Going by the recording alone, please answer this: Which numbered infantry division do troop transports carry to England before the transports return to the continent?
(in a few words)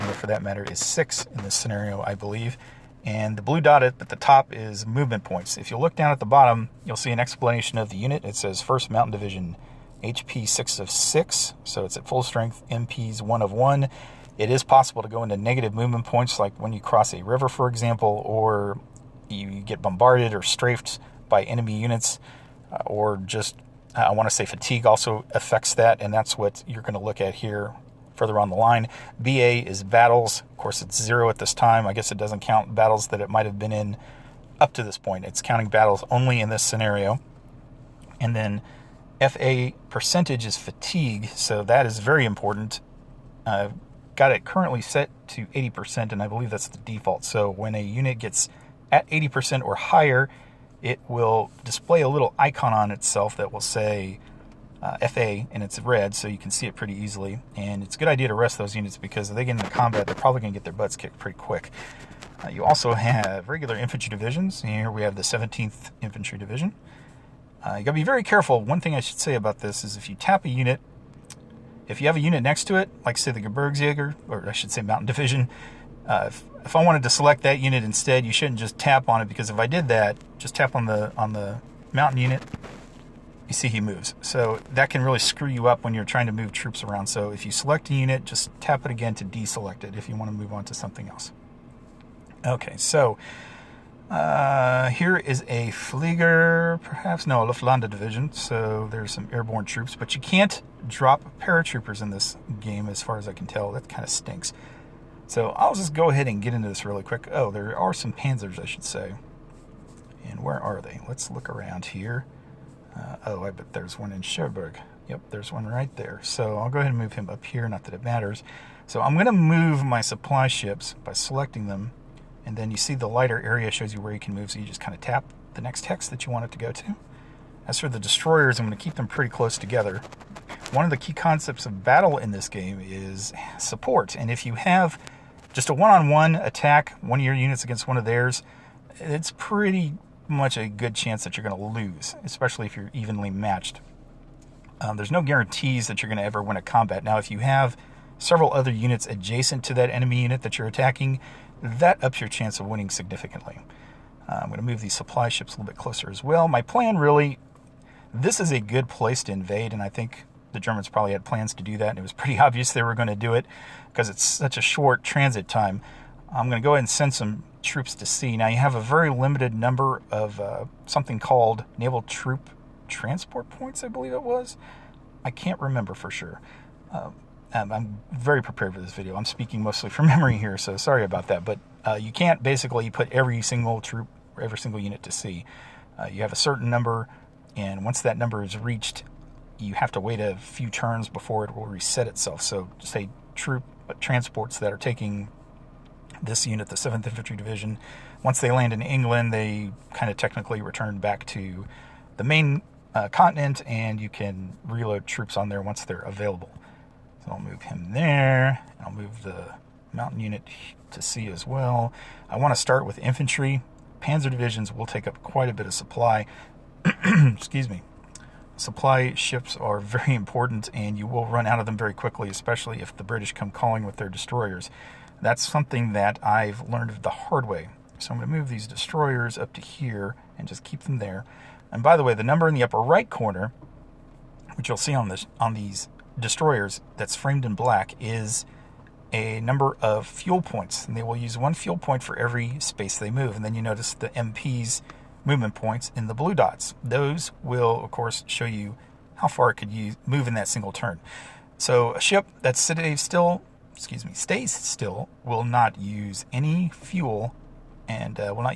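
7th.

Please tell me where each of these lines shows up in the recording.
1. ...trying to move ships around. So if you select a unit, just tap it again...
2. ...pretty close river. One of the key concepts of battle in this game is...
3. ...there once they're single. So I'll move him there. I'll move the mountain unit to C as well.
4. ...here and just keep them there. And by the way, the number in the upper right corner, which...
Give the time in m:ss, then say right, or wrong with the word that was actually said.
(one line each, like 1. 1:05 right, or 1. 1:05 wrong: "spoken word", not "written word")
1. 1:26 wrong: "troops", not "ships"
2. 2:09 wrong: "together", not "river"
3. 3:25 wrong: "available", not "single"
4. 3:49 right.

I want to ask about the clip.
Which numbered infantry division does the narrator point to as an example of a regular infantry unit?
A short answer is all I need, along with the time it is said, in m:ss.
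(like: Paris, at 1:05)
17th, at 1:05.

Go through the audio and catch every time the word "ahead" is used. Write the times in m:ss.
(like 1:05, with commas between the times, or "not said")
1:46, 1:56, 2:46.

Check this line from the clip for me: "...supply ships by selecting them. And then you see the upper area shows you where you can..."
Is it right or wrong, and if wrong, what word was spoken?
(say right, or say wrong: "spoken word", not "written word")
wrong: "lighter", not "upper".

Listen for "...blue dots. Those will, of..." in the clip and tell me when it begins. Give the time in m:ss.
4:06.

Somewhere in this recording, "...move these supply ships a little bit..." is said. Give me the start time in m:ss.
2:34.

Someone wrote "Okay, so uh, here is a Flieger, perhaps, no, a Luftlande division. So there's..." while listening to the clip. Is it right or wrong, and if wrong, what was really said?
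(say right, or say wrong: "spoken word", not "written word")
right.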